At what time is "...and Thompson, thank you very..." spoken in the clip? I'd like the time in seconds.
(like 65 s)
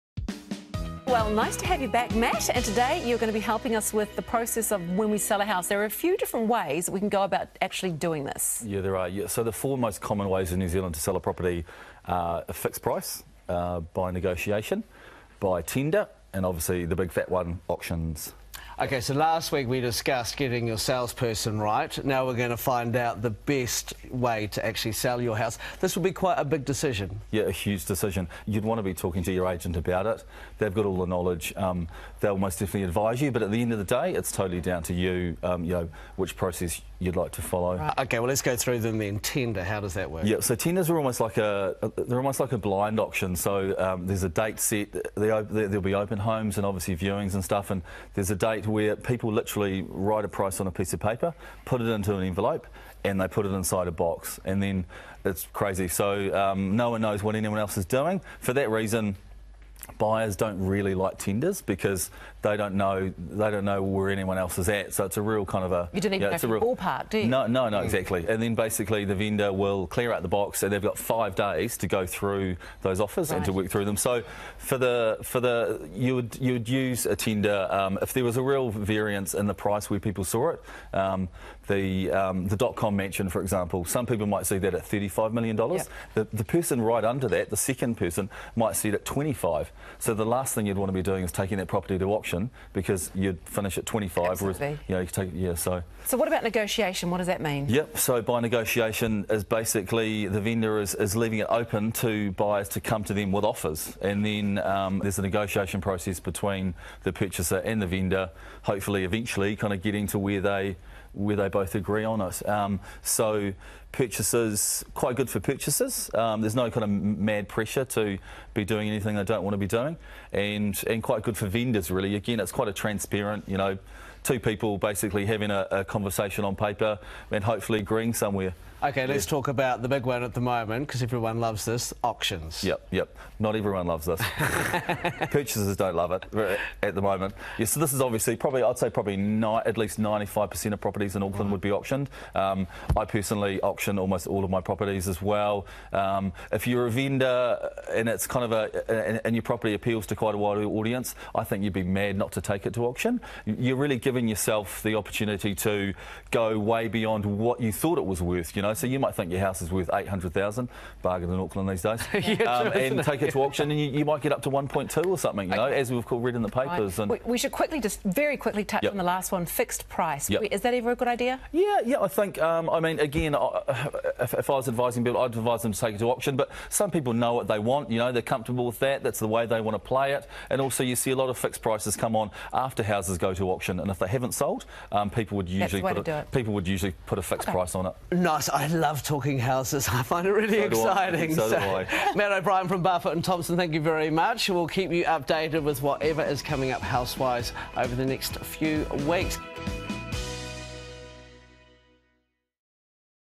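193 s.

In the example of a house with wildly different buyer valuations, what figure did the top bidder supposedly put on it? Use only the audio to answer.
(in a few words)
$35 million.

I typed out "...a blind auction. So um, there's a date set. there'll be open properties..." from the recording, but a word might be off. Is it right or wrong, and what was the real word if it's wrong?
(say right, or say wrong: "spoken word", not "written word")
wrong: "homes", not "properties".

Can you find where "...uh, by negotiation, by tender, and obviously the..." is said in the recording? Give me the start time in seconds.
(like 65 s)
13 s.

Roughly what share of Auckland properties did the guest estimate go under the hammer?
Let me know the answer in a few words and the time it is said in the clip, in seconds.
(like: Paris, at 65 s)
95%, at 139 s.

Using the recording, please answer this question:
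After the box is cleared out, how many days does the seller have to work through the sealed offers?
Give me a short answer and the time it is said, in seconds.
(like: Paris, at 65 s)
5, at 70 s.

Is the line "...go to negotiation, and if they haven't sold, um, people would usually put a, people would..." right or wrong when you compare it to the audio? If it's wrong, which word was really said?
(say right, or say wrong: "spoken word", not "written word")
wrong: "auction", not "negotiation".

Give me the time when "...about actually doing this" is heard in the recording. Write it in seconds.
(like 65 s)
7 s.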